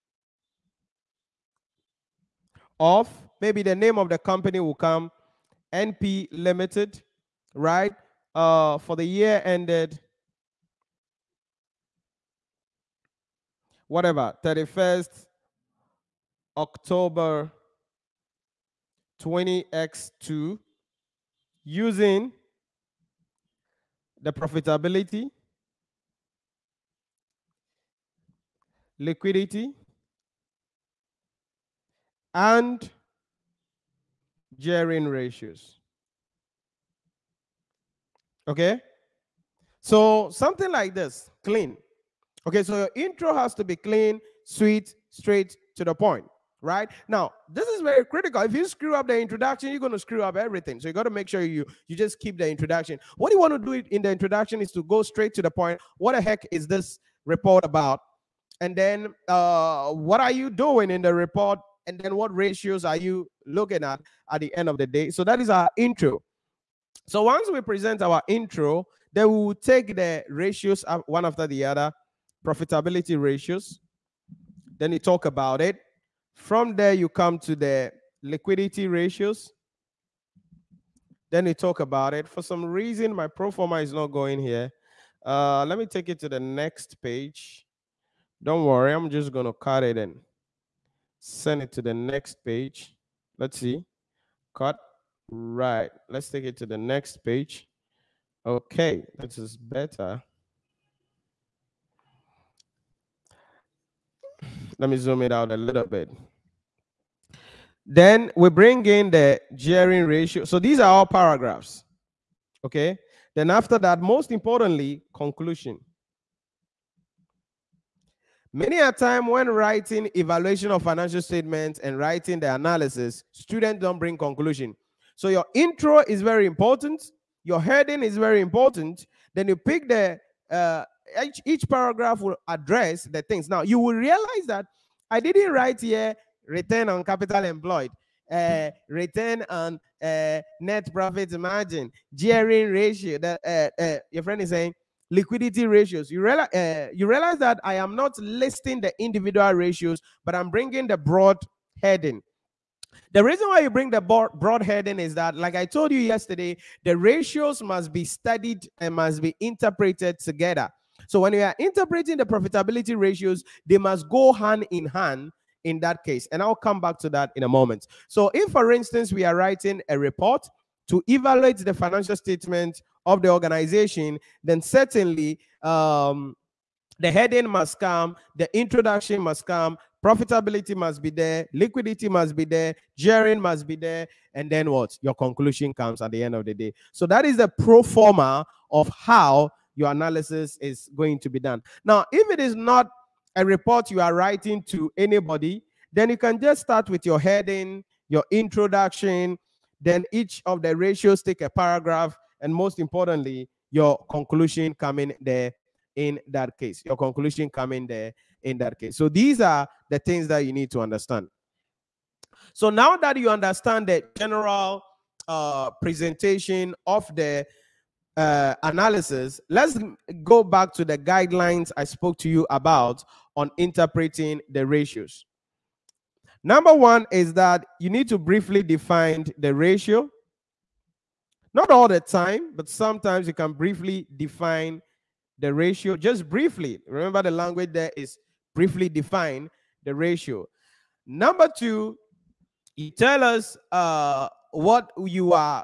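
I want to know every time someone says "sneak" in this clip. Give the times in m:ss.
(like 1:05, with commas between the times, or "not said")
not said.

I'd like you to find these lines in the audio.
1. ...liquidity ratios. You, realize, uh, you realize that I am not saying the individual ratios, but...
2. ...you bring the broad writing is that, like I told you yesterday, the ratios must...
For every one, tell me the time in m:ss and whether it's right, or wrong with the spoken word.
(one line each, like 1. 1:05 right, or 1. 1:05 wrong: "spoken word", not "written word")
1. 2:25 wrong: "listing", not "saying"
2. 2:33 wrong: "heading", not "writing".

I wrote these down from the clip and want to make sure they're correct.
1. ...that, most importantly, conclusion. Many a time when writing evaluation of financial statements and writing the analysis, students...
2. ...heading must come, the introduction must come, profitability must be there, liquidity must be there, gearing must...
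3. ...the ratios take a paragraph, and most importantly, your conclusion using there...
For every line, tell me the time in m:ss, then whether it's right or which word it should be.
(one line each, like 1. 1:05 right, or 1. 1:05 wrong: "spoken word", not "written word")
1. 1:53 right
2. 2:57 right
3. 3:20 wrong: "coming", not "using".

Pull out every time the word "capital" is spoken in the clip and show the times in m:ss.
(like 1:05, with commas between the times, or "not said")
2:17.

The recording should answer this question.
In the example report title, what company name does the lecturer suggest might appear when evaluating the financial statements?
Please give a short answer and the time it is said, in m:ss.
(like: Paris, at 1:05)
NP Limited, at 0:05.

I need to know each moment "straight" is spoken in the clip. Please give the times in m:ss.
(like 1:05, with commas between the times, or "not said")
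0:45, 0:55.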